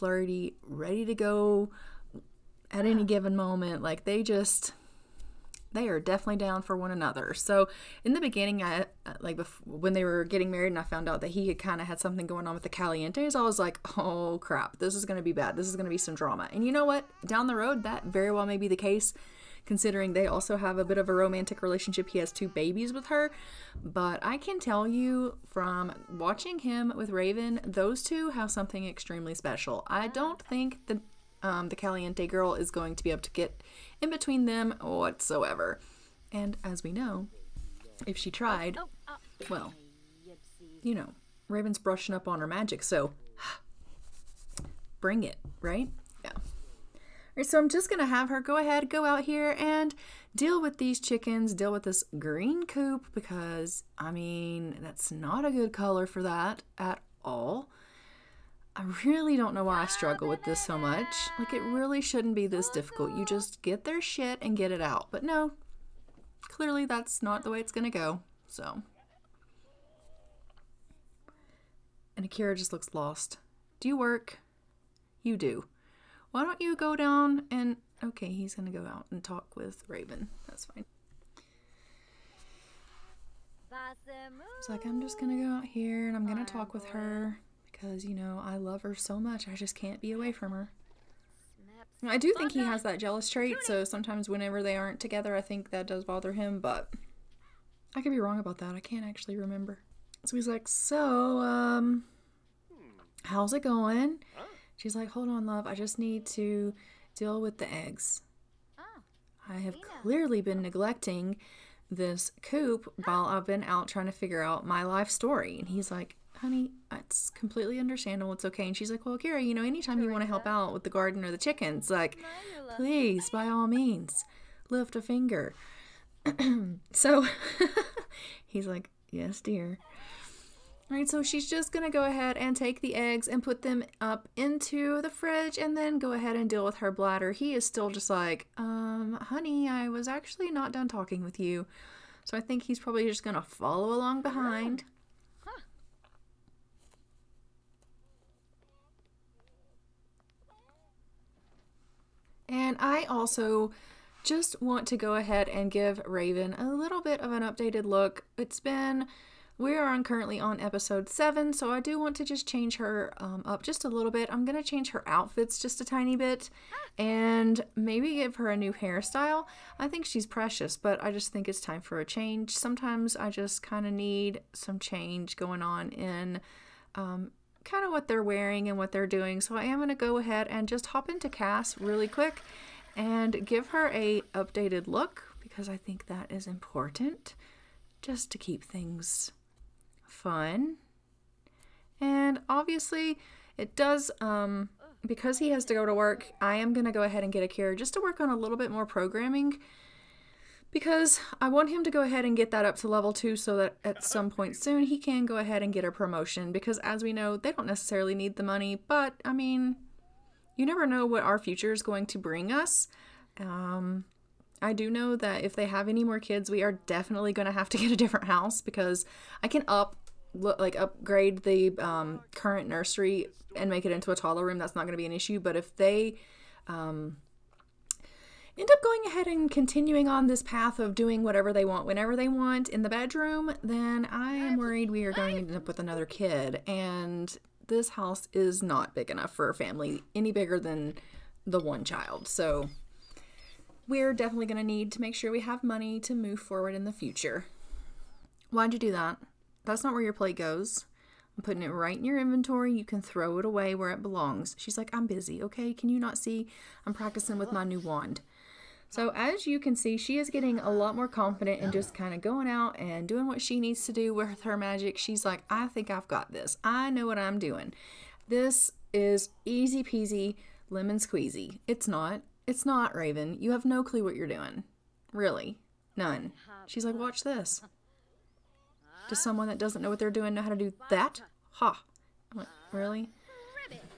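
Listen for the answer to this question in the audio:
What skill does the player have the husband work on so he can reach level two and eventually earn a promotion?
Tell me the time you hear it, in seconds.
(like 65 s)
198 s.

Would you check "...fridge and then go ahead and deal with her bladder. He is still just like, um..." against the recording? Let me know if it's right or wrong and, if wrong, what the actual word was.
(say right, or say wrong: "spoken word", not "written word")
right.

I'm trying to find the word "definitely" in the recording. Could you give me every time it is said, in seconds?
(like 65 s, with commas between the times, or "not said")
5 s, 216 s, 244 s.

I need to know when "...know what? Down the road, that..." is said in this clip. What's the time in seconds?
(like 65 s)
16 s.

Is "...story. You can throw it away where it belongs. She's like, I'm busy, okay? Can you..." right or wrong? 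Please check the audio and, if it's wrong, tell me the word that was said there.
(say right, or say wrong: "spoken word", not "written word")
wrong: "inventory", not "story".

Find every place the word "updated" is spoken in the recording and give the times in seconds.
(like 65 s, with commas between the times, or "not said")
157 s, 184 s.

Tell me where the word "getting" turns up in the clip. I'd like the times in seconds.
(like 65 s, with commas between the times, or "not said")
10 s, 260 s.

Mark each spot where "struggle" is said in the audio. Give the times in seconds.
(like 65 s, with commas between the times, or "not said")
59 s.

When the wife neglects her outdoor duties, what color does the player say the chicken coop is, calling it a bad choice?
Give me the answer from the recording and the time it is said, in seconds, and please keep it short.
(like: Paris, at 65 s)
Green, at 52 s.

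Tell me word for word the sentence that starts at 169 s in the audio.
I think she's precious, but I just think it's time for a change.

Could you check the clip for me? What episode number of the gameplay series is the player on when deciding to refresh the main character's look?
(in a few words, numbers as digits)
7.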